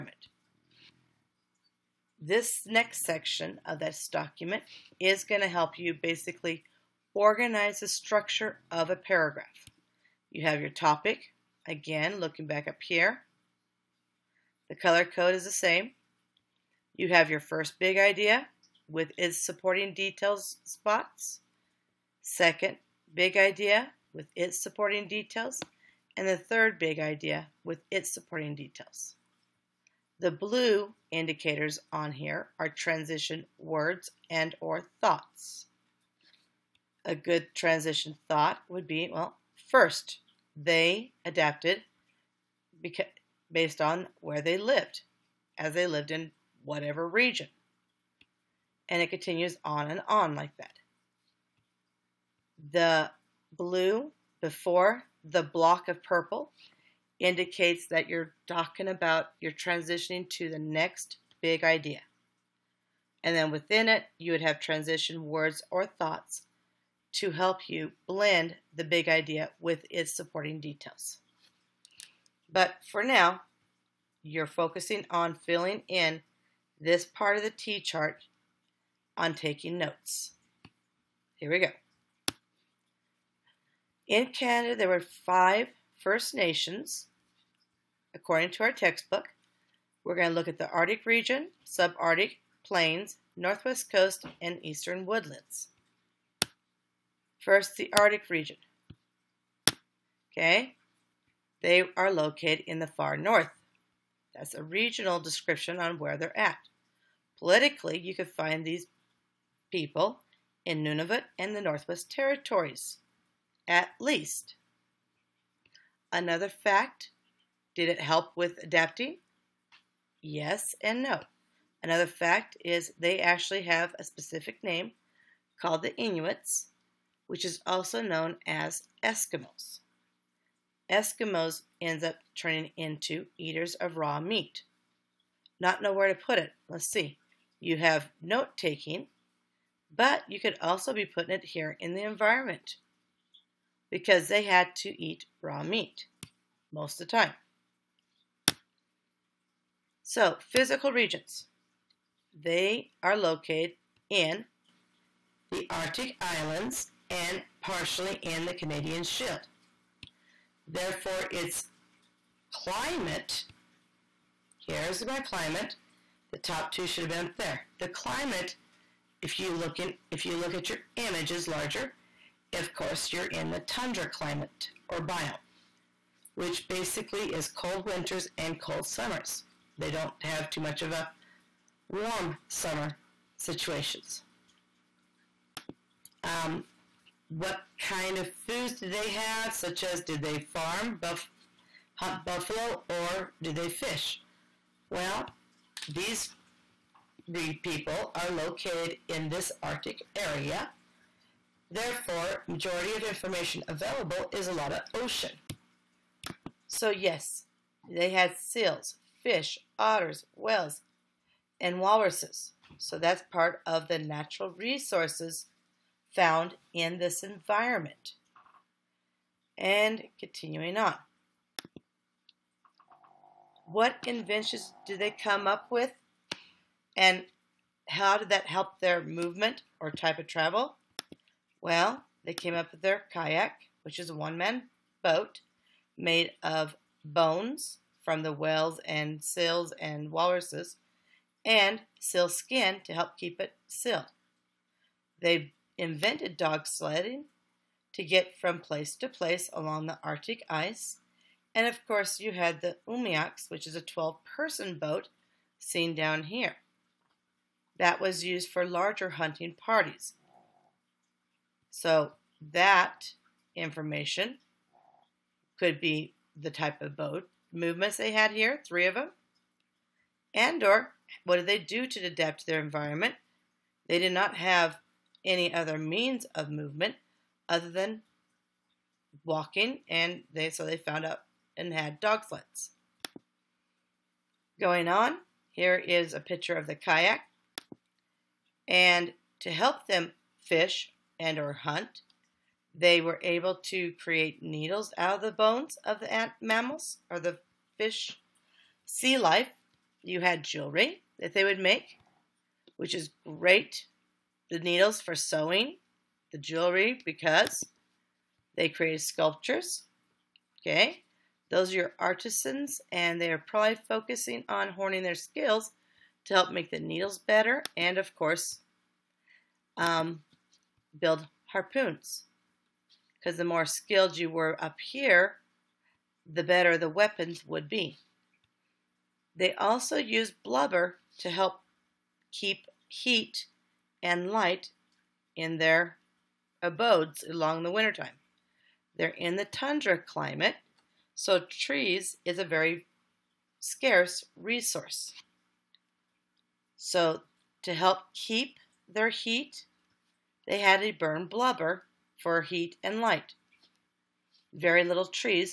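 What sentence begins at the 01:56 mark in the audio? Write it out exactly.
Another fact, did it help with adapting?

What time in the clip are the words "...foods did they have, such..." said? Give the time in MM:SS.
03:08.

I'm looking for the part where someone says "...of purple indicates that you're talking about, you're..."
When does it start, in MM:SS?
00:55.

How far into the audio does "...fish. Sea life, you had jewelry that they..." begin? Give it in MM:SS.
04:57.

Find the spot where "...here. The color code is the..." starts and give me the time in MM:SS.
00:12.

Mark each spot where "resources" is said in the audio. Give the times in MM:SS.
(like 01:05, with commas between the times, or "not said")
03:34, 05:44.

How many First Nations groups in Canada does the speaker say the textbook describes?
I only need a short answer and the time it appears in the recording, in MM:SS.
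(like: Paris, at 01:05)
5, at 01:25.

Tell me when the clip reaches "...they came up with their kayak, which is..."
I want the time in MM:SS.
03:52.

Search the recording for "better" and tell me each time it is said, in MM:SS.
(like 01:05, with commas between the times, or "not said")
05:17, 05:26.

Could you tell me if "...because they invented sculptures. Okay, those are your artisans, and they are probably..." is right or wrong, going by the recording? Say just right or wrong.
wrong.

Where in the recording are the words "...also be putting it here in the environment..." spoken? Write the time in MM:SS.
02:20.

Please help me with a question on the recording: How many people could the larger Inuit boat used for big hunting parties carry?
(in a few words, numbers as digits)
12.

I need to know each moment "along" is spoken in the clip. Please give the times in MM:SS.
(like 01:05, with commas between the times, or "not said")
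04:09, 05:37.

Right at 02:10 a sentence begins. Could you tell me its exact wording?
Eskimos ends up turning into eaters of raw meat.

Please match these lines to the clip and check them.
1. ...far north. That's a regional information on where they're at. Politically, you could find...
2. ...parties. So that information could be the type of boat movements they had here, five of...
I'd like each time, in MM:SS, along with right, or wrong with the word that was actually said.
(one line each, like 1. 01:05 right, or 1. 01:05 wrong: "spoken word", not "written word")
1. 01:42 wrong: "description", not "information"
2. 04:19 wrong: "three", not "five".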